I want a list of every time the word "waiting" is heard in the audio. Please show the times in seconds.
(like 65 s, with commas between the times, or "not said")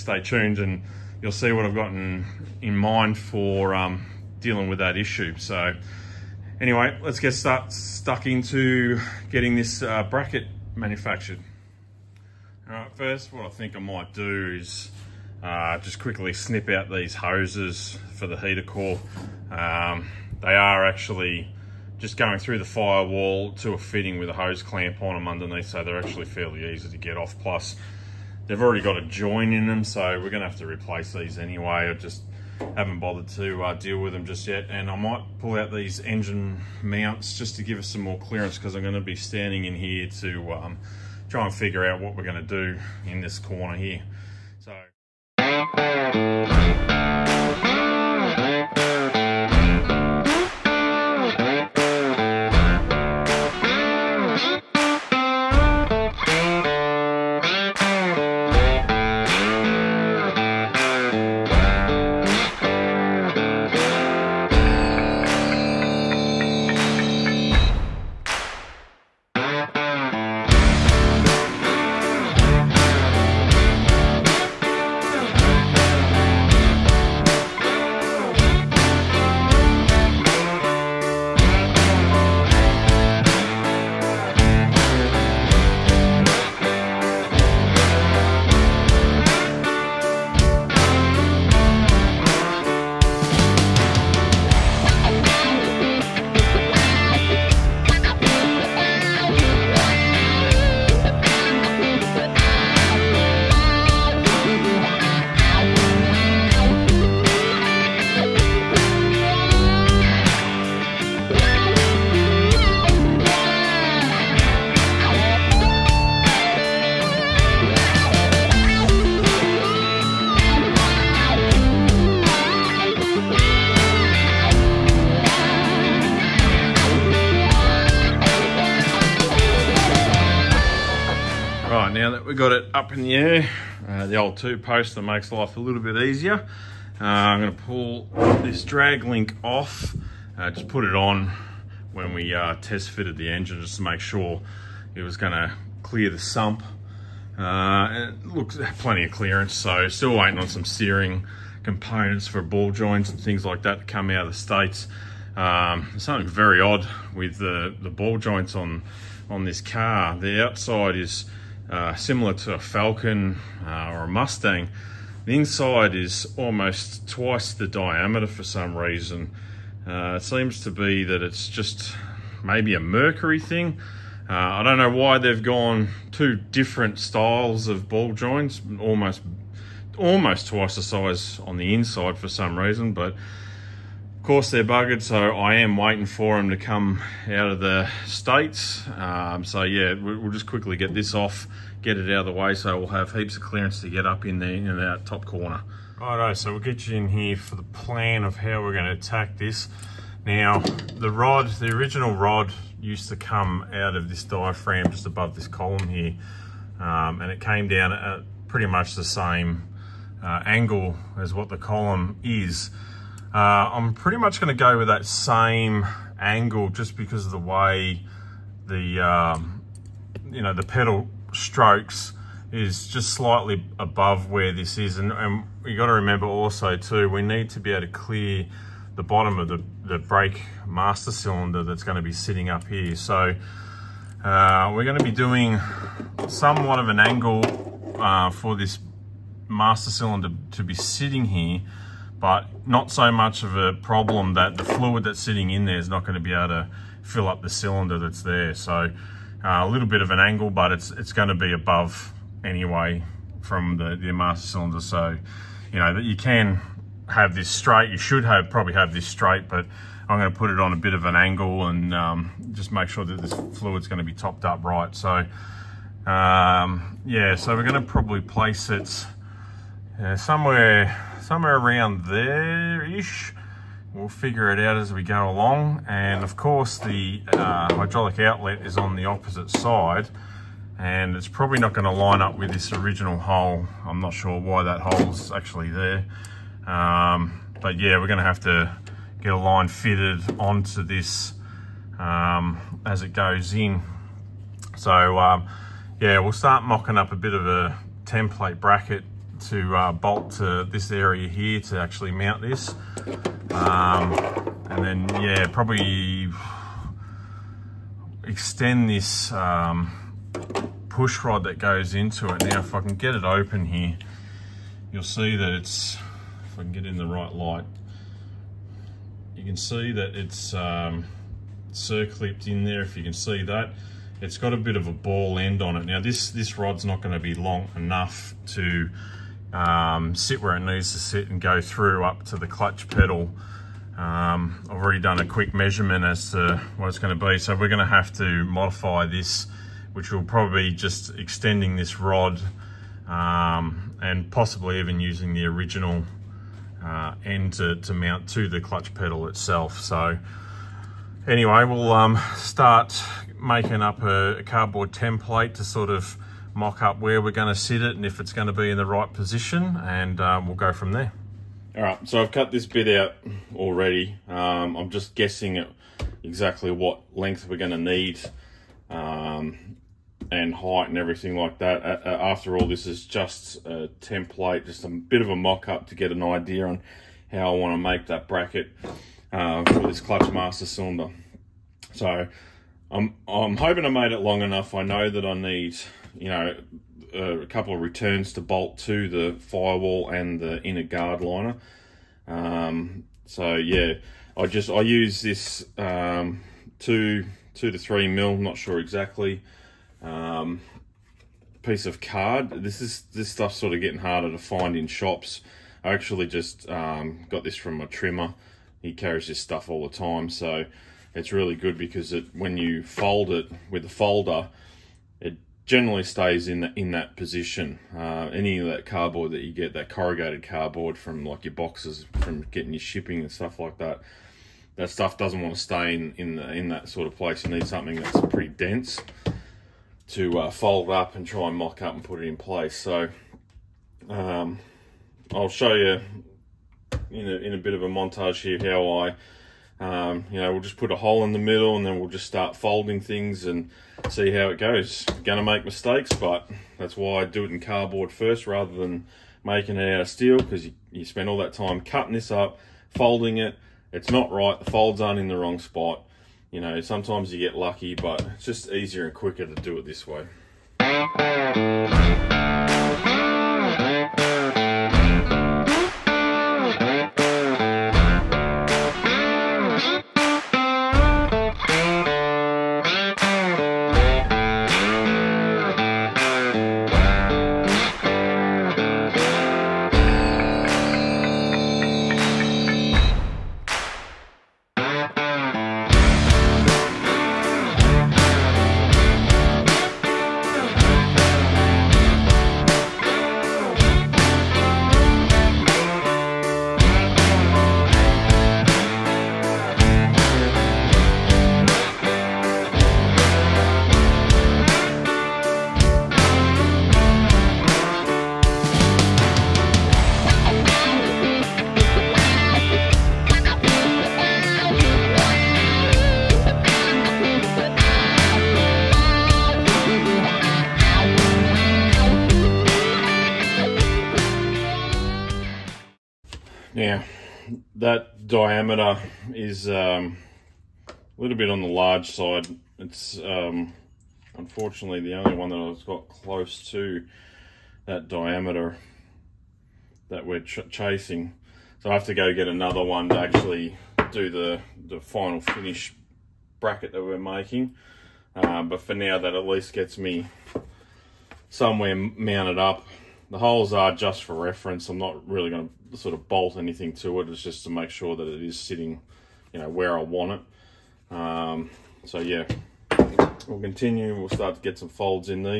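150 s, 185 s.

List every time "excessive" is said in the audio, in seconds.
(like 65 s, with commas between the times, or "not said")
not said.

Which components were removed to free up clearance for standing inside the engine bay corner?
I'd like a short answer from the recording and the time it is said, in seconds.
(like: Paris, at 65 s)
Engine mounts, at 35 s.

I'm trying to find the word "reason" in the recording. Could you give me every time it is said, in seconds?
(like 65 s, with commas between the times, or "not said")
168 s, 182 s.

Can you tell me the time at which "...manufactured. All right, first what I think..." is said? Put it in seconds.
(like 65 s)
10 s.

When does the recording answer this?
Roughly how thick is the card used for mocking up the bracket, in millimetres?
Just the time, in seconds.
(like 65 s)
397 s.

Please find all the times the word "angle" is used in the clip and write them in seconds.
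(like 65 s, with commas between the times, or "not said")
210 s, 216 s, 236 s, 250 s, 261 s.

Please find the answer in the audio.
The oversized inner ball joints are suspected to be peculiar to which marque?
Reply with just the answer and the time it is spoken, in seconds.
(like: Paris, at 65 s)
Mercury, at 172 s.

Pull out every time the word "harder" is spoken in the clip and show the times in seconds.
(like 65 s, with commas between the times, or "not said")
403 s.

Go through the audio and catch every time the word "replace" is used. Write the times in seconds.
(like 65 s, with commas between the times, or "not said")
30 s.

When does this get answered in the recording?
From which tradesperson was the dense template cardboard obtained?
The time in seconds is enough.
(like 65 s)
407 s.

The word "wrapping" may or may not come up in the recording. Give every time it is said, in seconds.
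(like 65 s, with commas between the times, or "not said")
not said.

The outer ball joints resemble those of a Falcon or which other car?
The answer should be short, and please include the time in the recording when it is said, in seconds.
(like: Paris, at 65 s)
Mustang, at 164 s.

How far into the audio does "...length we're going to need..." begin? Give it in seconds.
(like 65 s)
367 s.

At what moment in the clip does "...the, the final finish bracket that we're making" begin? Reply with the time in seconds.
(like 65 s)
544 s.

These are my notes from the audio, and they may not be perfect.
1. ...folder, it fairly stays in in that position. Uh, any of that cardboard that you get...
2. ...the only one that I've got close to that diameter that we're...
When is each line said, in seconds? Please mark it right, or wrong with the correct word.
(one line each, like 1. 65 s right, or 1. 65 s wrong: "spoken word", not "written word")
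1. 413 s wrong: "generally", not "fairly"
2. 534 s right.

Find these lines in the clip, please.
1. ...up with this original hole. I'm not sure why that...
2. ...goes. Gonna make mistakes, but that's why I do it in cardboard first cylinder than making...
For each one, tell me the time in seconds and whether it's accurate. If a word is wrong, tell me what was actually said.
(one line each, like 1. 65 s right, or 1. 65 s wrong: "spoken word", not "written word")
1. 282 s right
2. 444 s wrong: "rather", not "cylinder".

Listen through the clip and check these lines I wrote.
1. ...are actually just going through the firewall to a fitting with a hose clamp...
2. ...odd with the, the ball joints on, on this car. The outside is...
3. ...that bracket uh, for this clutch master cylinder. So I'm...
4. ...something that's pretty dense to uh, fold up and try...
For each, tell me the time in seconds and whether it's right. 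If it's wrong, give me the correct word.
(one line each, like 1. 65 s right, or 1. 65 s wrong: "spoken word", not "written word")
1. 20 s right
2. 156 s right
3. 378 s right
4. 427 s right.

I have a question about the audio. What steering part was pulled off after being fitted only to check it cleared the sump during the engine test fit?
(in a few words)
Drag link.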